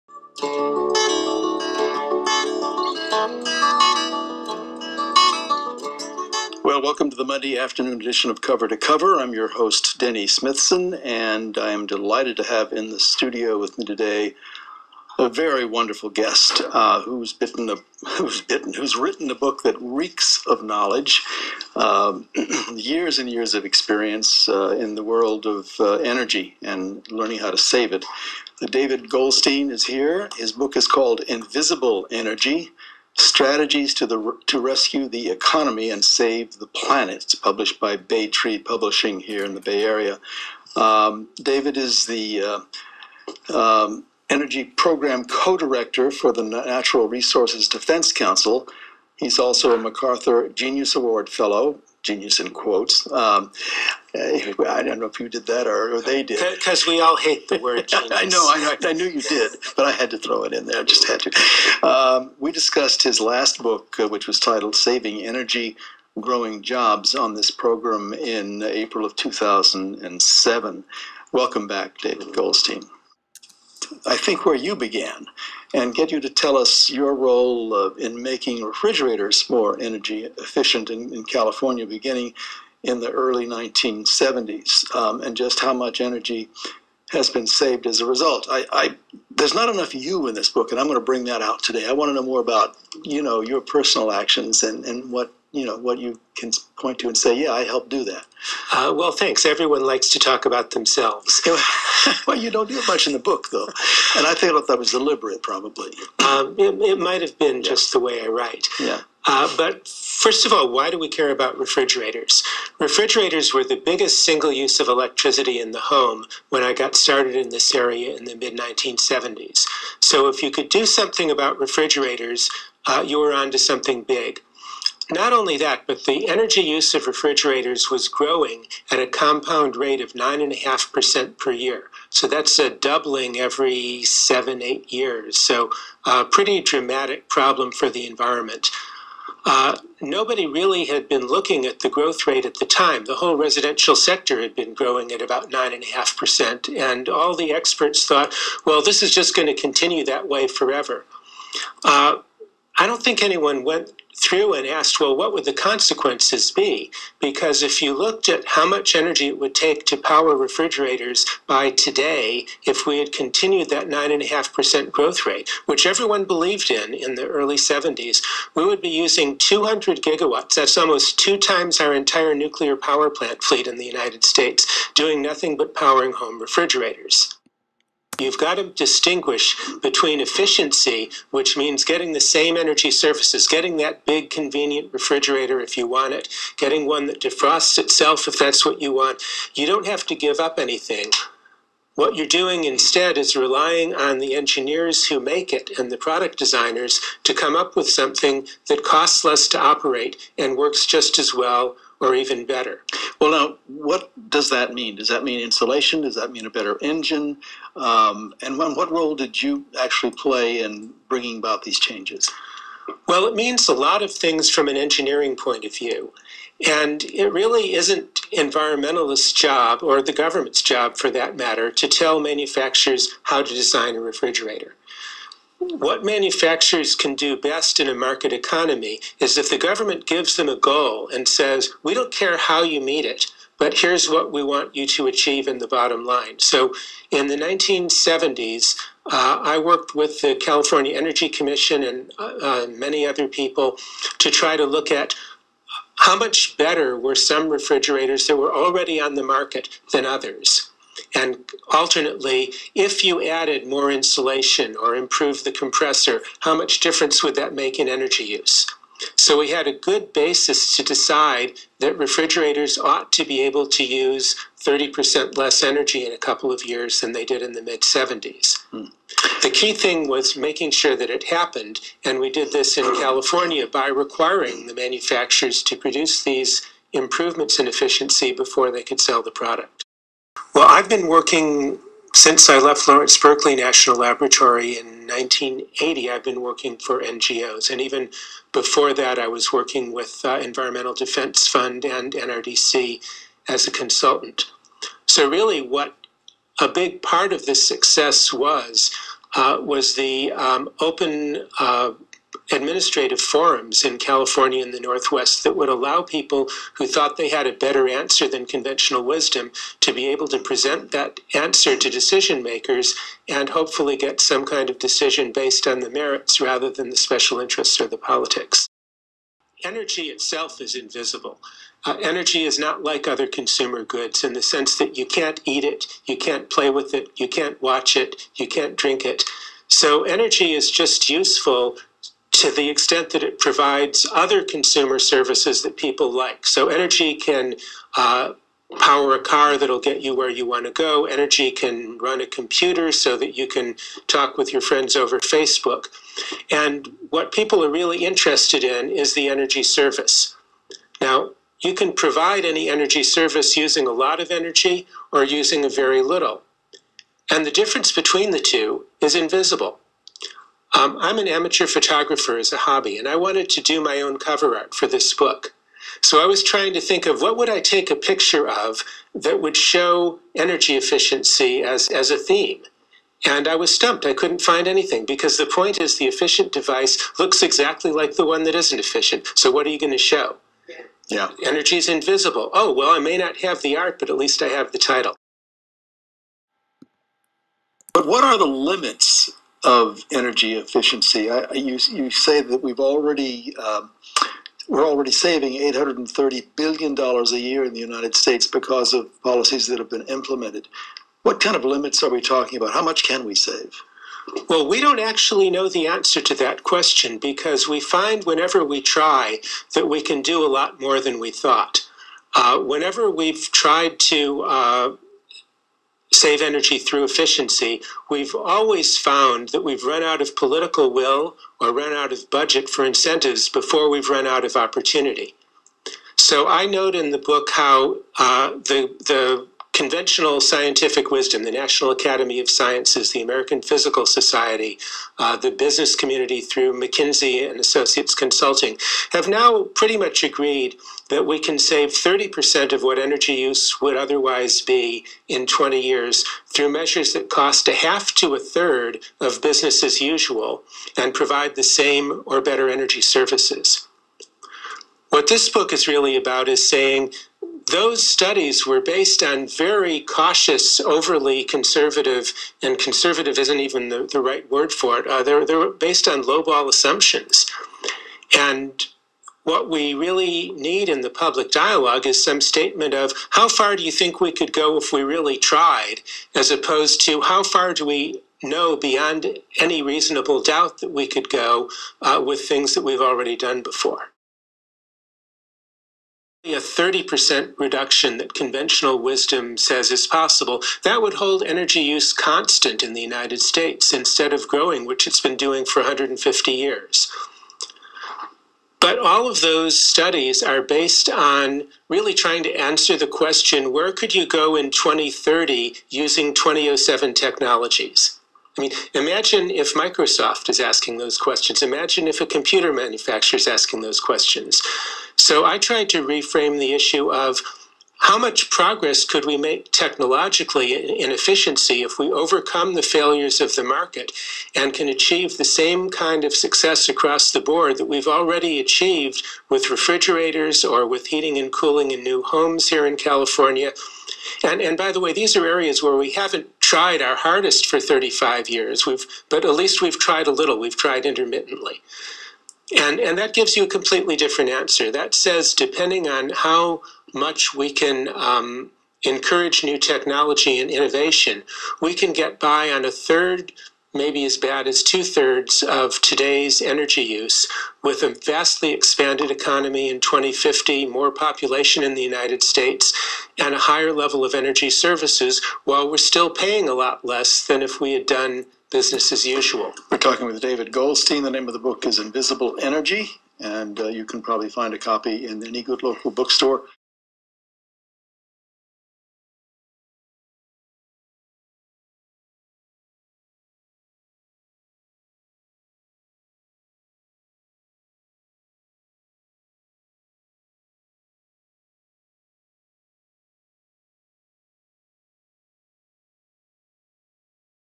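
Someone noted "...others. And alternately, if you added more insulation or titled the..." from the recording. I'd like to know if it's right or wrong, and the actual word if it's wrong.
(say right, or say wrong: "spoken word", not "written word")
wrong: "improved", not "titled".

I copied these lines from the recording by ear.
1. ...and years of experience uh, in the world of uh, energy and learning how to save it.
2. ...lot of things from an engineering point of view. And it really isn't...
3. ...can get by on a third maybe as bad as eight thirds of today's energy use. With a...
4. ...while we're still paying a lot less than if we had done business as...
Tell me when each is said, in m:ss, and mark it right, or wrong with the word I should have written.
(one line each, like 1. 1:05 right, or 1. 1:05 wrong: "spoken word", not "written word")
1. 0:23 right
2. 3:33 right
3. 9:11 wrong: "two", not "eight"
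4. 9:25 right.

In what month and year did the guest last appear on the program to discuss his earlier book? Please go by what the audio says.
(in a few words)
April 2007.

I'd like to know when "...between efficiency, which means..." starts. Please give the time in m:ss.
2:59.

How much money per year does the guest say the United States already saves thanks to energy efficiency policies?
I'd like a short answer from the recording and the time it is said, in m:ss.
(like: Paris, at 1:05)
$830 billion, at 6:35.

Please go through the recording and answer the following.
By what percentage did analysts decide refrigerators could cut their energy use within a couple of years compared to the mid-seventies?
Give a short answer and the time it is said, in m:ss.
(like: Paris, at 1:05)
30%, at 4:24.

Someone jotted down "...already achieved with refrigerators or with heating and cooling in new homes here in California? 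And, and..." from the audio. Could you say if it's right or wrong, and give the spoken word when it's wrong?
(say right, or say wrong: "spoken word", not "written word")
right.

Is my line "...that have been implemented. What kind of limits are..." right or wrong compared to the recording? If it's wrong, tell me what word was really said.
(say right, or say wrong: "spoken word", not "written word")
right.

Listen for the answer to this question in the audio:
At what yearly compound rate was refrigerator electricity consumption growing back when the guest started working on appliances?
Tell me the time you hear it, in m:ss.
2:10.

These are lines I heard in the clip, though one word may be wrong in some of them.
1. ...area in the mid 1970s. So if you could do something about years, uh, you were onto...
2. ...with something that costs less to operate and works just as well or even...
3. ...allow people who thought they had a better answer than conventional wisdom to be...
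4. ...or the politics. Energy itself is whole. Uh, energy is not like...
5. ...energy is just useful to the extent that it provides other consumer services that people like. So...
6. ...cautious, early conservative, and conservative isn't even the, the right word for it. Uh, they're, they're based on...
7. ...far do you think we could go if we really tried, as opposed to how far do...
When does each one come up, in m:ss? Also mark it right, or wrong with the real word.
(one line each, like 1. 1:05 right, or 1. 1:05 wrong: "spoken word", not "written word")
1. 1:57 wrong: "refrigerators", not "years"
2. 3:17 right
3. 5:05 right
4. 5:17 wrong: "invisible", not "whole"
5. 5:30 right
6. 7:40 wrong: "overly", not "early"
7. 7:53 right.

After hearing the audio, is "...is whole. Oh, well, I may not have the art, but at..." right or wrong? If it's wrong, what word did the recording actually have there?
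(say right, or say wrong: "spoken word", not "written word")
wrong: "invisible", not "whole".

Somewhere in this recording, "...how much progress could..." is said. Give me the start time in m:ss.
8:37.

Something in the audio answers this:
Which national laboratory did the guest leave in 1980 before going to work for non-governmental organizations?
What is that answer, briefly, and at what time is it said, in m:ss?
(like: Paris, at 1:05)
Lawrence Berkeley National Laboratory, at 4:42.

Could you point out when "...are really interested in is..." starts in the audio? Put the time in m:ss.
5:47.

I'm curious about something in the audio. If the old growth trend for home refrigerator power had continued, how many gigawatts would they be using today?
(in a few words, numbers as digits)
200 gigawatts.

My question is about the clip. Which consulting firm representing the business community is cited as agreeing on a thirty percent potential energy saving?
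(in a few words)
McKinsey and Associates.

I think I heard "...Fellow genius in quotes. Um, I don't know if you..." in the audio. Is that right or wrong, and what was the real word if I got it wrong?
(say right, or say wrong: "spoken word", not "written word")
right.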